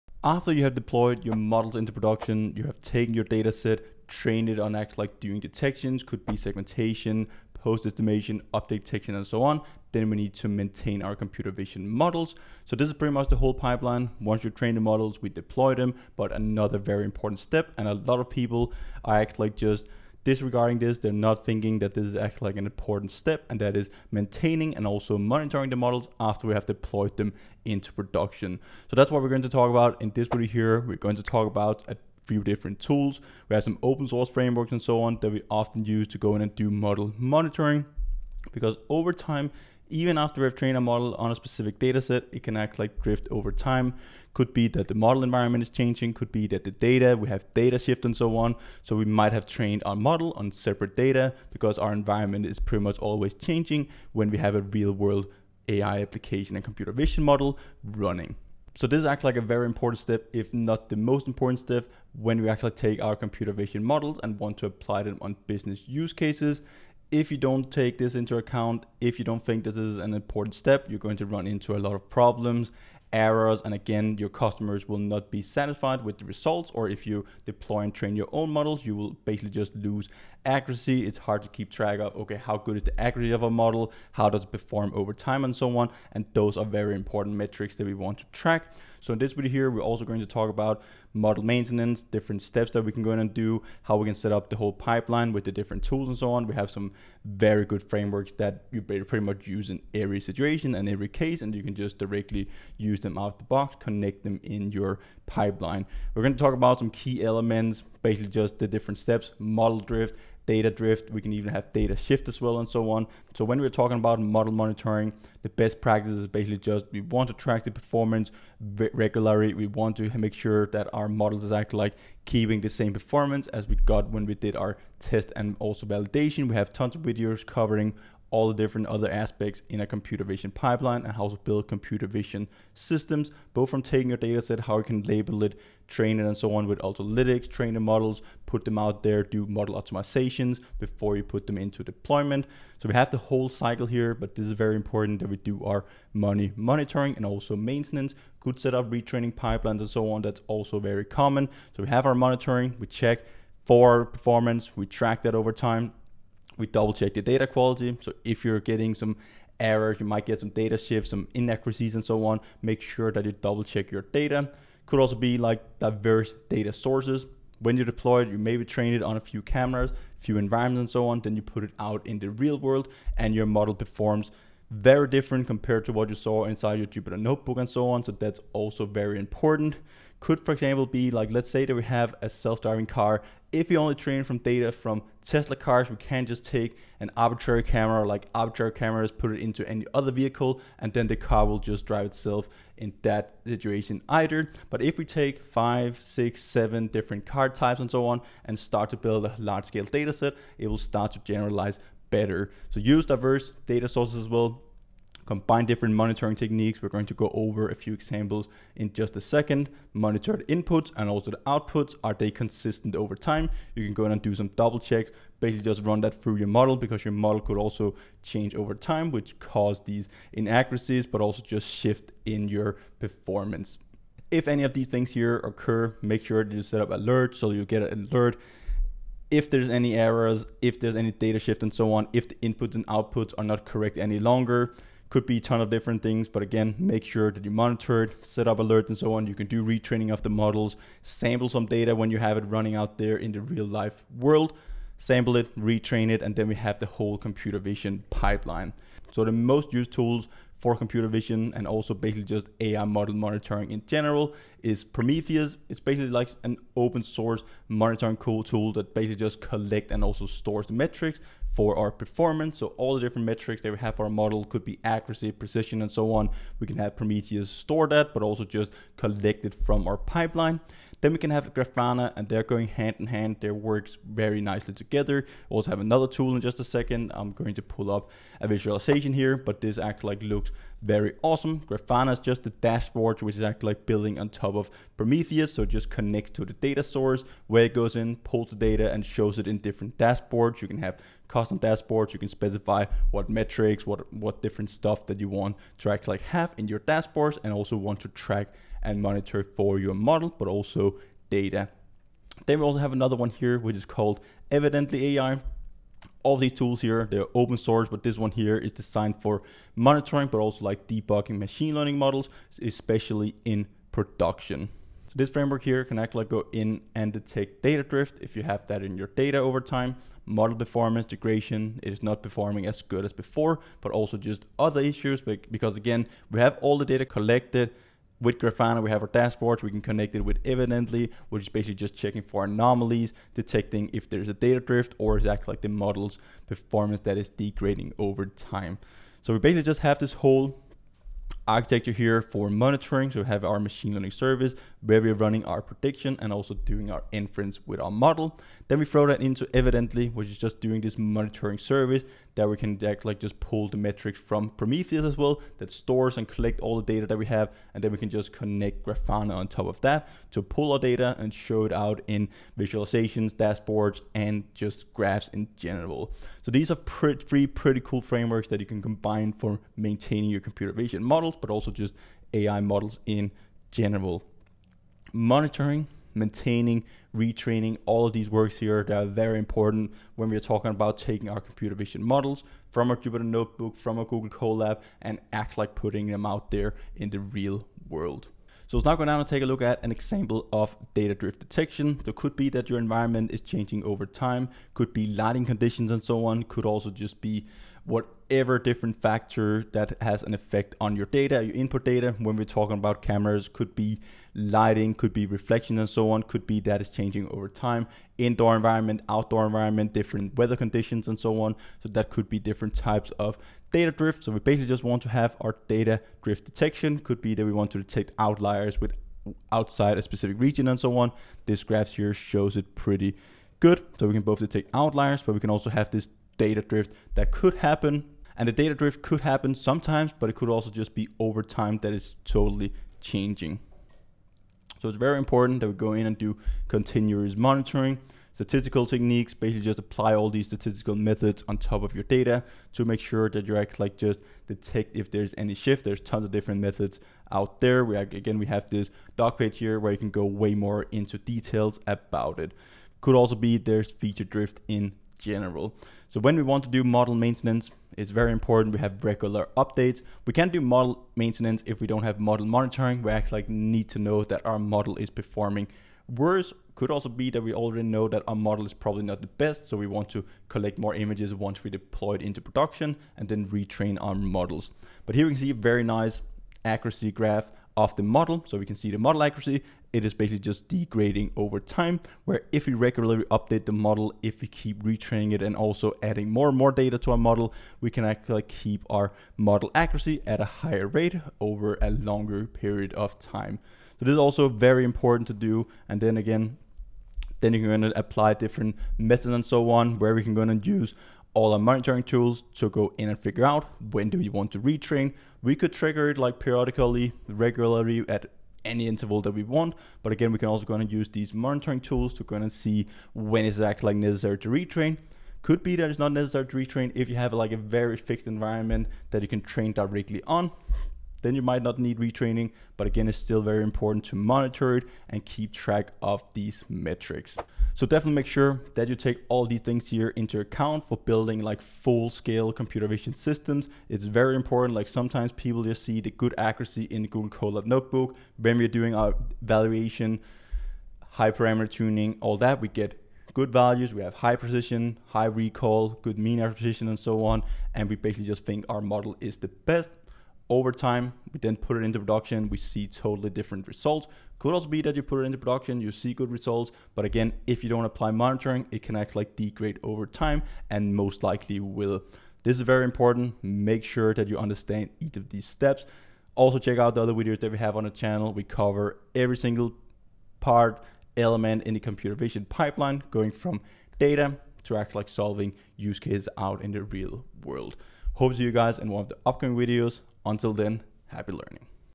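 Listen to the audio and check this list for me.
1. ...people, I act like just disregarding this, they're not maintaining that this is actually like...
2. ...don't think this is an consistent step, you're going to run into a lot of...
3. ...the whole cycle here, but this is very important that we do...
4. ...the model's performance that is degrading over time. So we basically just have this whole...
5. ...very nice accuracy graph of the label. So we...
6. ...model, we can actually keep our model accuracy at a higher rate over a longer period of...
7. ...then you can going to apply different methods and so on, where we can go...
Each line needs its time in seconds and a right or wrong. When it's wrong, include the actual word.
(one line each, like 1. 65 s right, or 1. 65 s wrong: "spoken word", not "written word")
1. 18 s wrong: "thinking", not "maintaining"
2. 69 s wrong: "important", not "consistent"
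3. 143 s right
4. 335 s right
5. 475 s wrong: "model", not "label"
6. 487 s right
7. 497 s right.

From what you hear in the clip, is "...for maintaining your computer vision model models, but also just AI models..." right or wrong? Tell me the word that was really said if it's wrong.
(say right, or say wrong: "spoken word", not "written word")
right.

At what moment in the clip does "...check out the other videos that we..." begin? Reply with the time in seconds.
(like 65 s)
566 s.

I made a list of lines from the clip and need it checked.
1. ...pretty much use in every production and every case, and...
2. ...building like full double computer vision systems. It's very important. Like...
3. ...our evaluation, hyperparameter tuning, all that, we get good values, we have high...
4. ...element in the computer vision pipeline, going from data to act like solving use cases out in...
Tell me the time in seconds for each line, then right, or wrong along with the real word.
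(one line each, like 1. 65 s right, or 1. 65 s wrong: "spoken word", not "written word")
1. 98 s wrong: "situation", not "production"
2. 530 s wrong: "scale", not "double"
3. 538 s right
4. 571 s right.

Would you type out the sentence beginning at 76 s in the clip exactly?
Or if you deploy and train your own models, you will basically just lose accuracy.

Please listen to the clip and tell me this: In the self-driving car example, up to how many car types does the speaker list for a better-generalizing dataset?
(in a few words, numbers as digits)
7.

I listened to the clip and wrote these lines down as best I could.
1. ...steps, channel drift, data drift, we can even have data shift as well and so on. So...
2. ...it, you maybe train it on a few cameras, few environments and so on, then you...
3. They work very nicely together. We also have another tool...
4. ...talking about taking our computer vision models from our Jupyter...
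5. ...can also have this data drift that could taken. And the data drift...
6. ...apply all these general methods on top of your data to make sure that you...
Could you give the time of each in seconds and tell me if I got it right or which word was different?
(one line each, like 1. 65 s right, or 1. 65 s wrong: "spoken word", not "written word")
1. 108 s wrong: "model", not "channel"
2. 168 s right
3. 273 s right
4. 380 s right
5. 425 s wrong: "happen", not "taken"
6. 439 s wrong: "statistical", not "general".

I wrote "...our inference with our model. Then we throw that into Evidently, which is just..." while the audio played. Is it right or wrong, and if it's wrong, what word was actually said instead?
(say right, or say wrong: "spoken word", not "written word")
right.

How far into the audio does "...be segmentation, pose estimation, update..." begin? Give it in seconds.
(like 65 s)
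6 s.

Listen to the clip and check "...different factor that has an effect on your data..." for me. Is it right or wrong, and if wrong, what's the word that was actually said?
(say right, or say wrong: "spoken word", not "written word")
right.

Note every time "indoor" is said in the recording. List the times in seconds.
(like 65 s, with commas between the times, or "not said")
408 s.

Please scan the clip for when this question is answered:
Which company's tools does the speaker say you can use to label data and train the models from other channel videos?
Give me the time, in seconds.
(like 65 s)
136 s.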